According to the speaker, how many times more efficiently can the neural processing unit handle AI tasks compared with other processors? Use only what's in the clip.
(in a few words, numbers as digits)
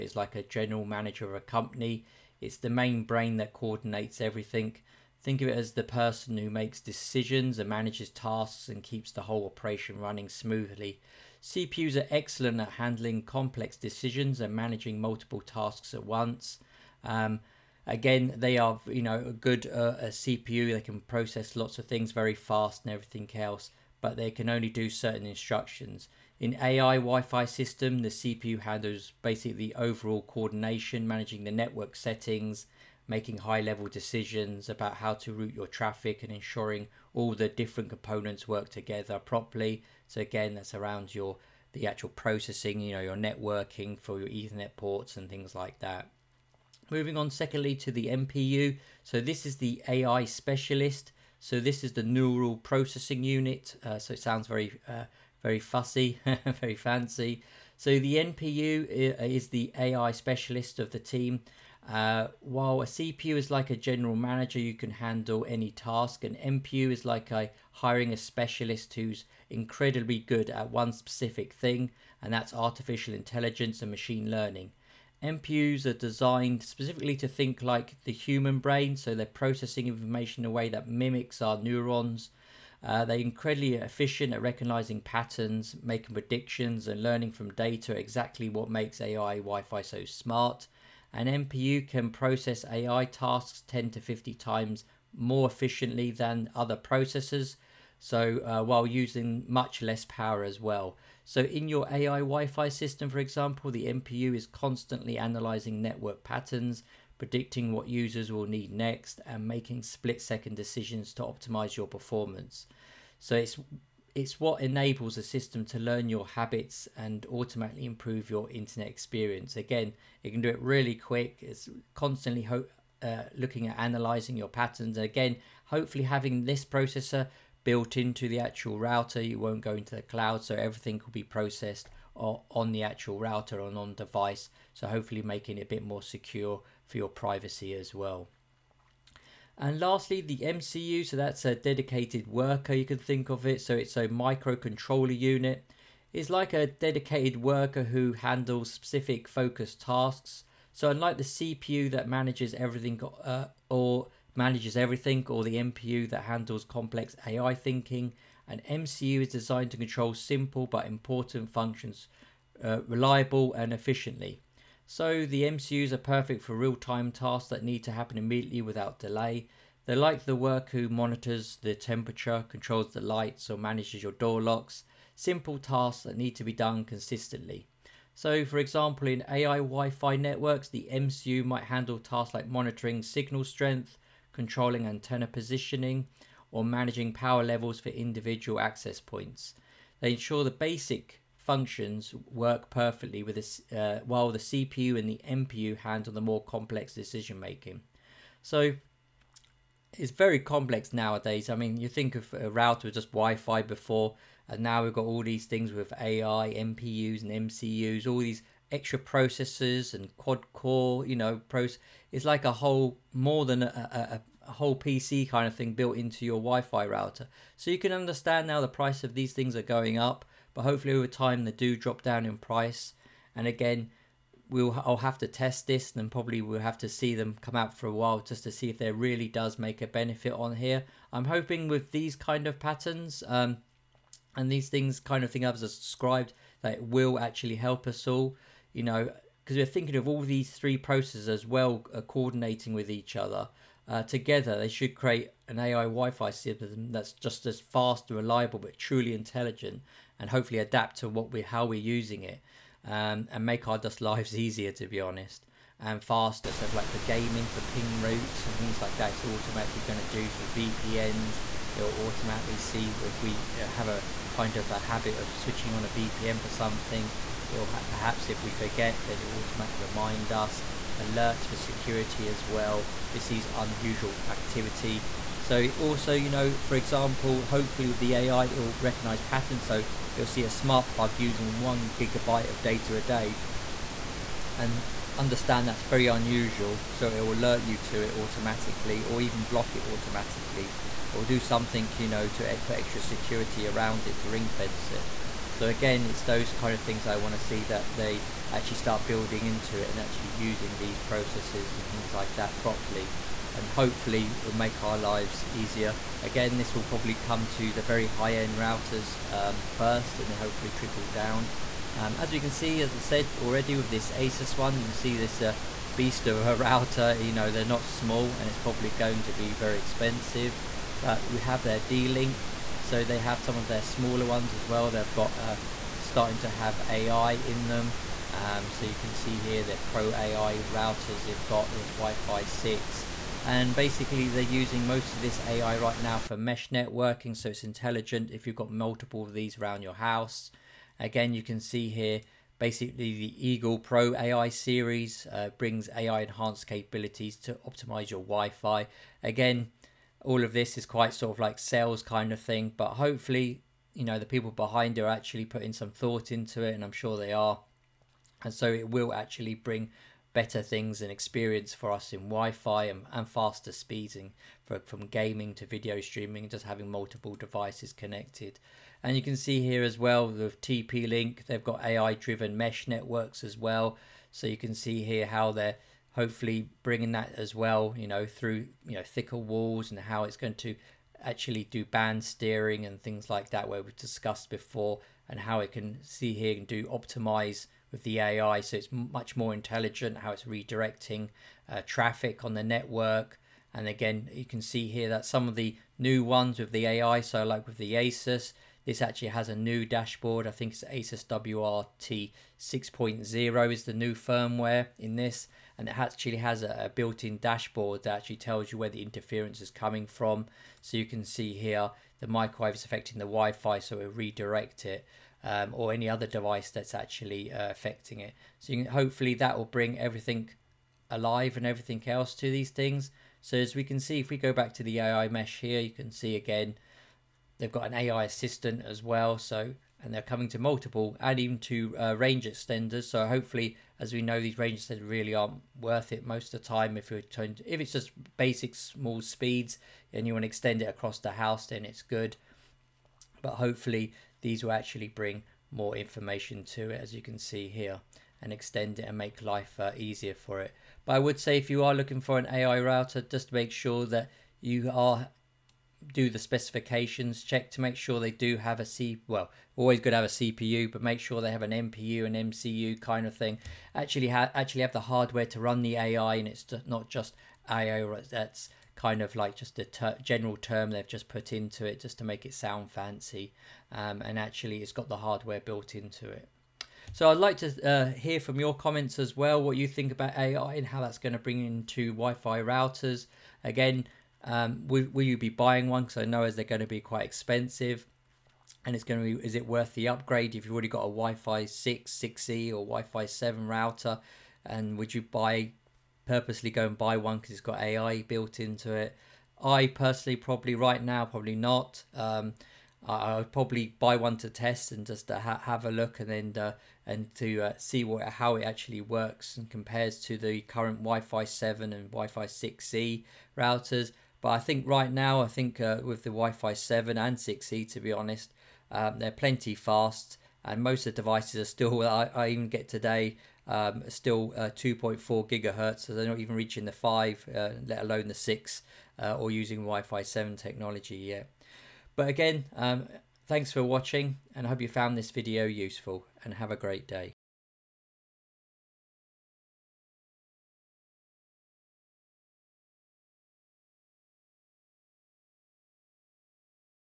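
10 to 50 times.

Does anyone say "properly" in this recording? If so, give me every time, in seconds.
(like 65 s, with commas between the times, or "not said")
39 s, 302 s.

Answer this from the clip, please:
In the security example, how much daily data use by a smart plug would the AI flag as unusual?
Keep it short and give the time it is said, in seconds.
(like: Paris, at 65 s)
1 gigabyte, at 281 s.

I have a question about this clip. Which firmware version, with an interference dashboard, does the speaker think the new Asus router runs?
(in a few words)
Asus WRT 6.0.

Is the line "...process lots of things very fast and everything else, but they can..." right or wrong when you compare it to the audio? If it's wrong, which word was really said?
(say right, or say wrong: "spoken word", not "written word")
right.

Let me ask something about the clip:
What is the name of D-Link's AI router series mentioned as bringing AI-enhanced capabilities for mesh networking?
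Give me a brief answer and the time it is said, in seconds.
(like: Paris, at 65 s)
Eagle Pro AI, at 343 s.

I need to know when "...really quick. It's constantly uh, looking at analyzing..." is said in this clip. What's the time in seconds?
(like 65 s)
120 s.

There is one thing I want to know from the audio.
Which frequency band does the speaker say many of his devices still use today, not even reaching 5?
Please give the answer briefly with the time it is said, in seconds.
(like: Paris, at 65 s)
2.4 gigahertz, at 524 s.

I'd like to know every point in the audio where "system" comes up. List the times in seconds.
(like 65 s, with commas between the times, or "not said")
27 s, 102 s, 115 s, 246 s.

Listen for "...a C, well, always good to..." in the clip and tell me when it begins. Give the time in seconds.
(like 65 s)
458 s.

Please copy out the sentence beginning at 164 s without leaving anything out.
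So the MCUs are perfect for real-time tasks that need to happen immediately without delay.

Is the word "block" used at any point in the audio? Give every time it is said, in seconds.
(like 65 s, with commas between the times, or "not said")
289 s.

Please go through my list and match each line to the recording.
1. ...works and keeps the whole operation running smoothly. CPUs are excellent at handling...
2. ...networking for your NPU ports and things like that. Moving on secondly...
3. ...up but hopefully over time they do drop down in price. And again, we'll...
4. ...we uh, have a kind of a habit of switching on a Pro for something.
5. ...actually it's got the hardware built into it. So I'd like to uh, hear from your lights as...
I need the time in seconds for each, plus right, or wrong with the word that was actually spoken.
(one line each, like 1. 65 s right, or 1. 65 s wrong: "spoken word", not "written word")
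1. 8 s wrong: "tasks", not "works"
2. 43 s wrong: "Ethernet", not "NPU"
3. 219 s right
4. 263 s wrong: "VPN", not "Pro"
5. 474 s wrong: "comments", not "lights".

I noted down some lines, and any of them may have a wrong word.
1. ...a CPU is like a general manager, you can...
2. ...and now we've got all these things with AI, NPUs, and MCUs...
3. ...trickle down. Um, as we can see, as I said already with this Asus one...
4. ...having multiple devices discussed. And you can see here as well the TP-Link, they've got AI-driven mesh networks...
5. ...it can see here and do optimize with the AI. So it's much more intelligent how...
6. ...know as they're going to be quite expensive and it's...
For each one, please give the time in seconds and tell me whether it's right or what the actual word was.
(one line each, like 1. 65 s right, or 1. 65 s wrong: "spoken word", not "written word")
1. 62 s right
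2. 204 s right
3. 310 s right
4. 366 s wrong: "connected", not "discussed"
5. 385 s right
6. 486 s right.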